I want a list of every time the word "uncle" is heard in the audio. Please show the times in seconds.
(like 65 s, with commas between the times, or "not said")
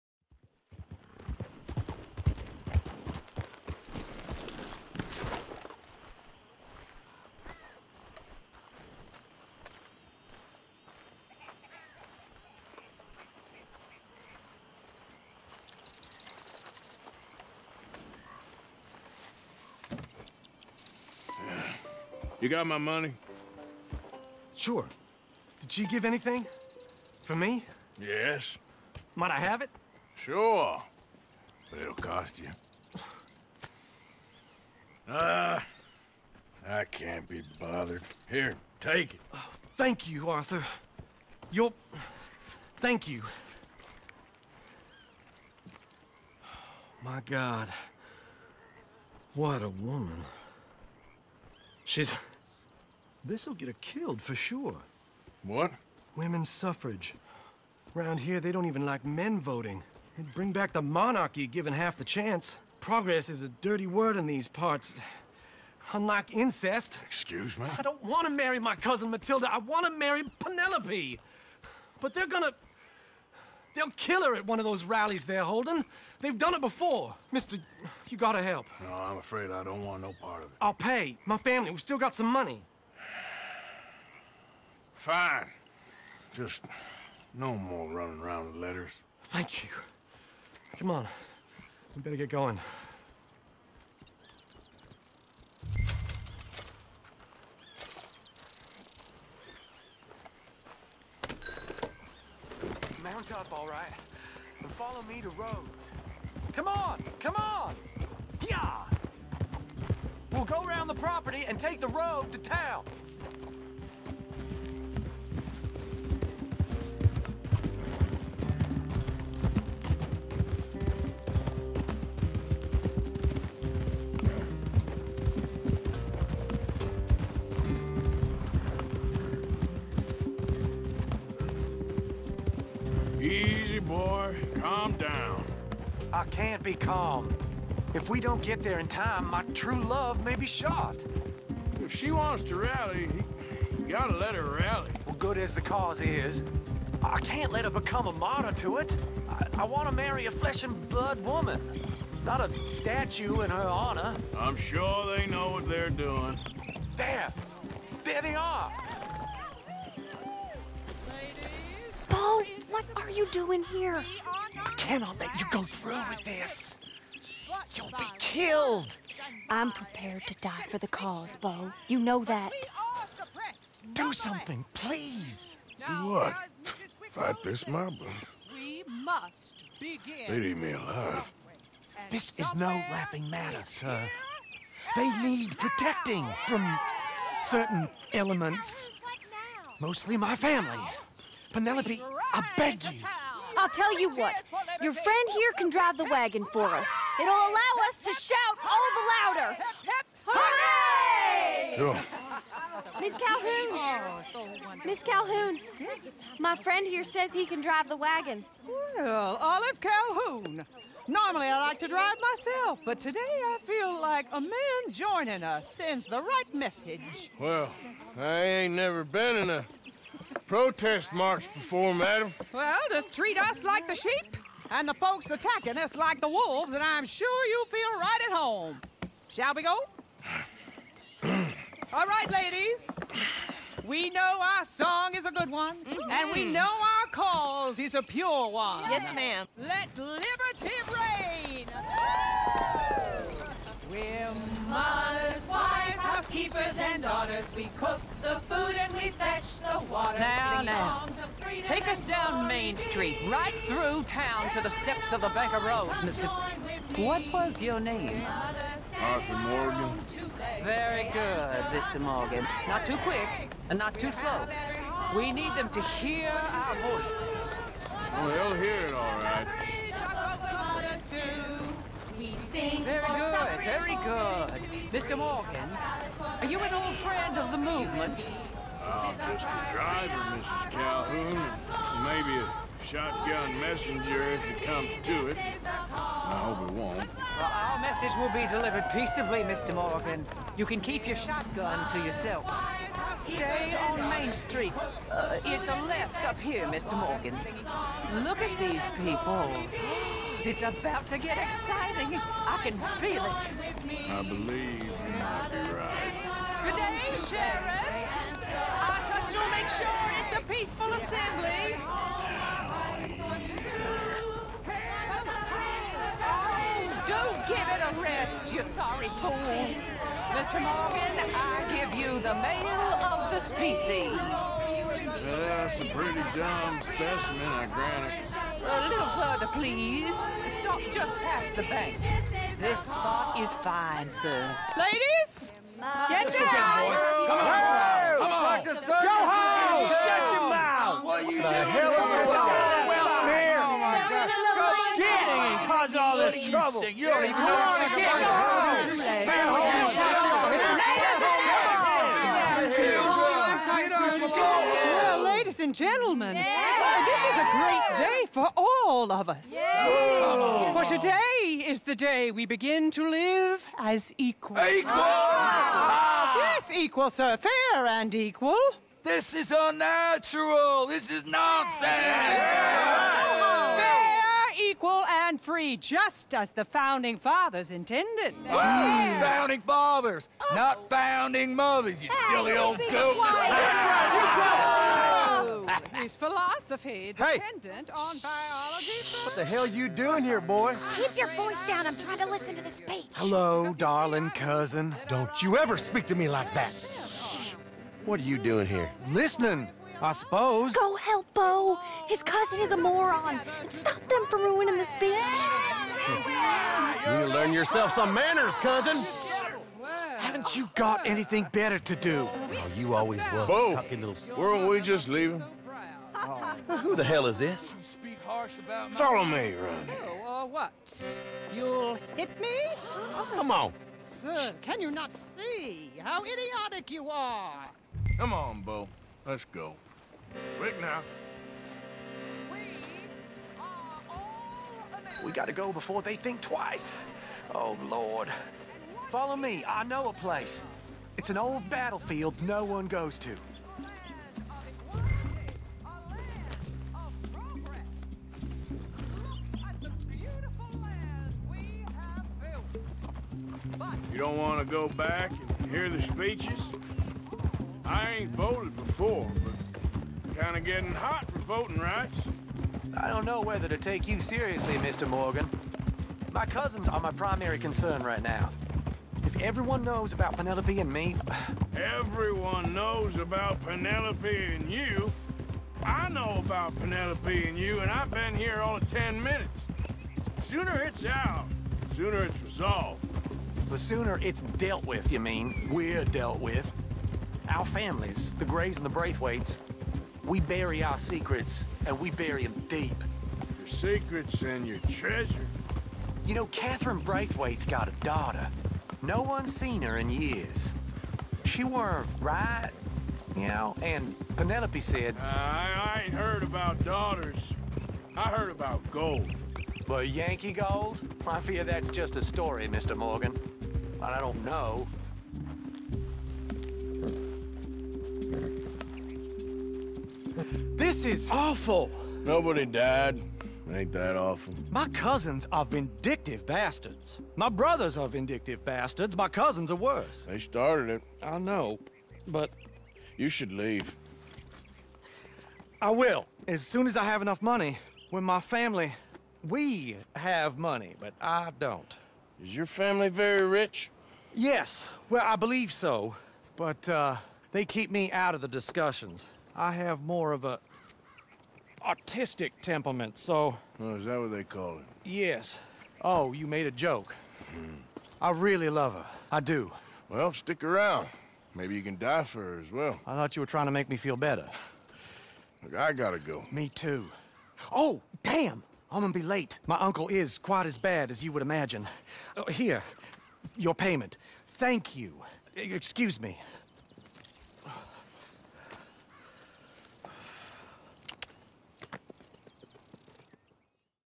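569 s.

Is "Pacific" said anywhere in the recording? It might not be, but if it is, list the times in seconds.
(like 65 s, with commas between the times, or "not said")
not said.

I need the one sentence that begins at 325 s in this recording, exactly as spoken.
that's a pretty dumb specimen, I grant it please.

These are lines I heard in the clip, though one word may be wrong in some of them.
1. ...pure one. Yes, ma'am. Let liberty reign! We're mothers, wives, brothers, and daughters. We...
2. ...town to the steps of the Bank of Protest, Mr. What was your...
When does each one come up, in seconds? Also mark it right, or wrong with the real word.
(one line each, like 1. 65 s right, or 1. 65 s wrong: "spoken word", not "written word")
1. 238 s wrong: "housekeepers", not "brothers"
2. 254 s wrong: "Rhodes", not "Protest".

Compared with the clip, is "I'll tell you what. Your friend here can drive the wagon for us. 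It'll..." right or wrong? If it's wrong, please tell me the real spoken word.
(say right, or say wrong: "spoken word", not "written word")
right.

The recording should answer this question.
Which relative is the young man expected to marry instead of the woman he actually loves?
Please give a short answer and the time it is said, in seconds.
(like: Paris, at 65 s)
Matilda, at 68 s.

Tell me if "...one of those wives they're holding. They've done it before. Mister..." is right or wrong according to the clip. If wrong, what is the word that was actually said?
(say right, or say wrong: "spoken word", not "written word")
wrong: "rallies", not "wives".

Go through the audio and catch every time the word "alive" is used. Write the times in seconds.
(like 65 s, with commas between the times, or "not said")
180 s.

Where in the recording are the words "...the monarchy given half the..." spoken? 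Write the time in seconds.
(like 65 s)
60 s.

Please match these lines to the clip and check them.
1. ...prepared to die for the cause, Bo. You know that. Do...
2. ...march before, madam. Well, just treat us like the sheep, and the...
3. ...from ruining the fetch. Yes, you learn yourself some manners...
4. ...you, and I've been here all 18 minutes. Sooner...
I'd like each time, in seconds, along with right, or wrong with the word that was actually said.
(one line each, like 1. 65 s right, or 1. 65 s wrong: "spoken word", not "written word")
1. 169 s right
2. 221 s right
3. 404 s wrong: "speech", not "fetch"
4. 477 s wrong: "10", not "18".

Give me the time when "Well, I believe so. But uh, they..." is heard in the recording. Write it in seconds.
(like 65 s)
545 s.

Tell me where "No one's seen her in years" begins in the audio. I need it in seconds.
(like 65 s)
499 s.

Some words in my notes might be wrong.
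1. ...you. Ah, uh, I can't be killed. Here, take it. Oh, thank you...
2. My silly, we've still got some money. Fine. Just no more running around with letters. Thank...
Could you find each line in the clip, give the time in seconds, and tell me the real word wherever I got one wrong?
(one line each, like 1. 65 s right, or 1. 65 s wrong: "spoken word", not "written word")
1. 32 s wrong: "bothered", not "killed"
2. 81 s wrong: "family", not "silly".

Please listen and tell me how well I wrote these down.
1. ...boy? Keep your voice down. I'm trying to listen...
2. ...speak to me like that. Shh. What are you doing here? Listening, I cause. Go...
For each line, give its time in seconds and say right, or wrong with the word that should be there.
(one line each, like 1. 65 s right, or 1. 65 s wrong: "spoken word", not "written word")
1. 390 s right
2. 395 s wrong: "suppose", not "cause".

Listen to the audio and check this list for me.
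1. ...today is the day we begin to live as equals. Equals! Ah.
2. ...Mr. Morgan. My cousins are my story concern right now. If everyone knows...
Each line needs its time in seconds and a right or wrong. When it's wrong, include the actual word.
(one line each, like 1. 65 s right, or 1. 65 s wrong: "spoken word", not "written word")
1. 360 s right
2. 464 s wrong: "primary", not "story".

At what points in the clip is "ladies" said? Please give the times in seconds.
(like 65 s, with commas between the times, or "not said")
232 s, 334 s, 349 s, 355 s.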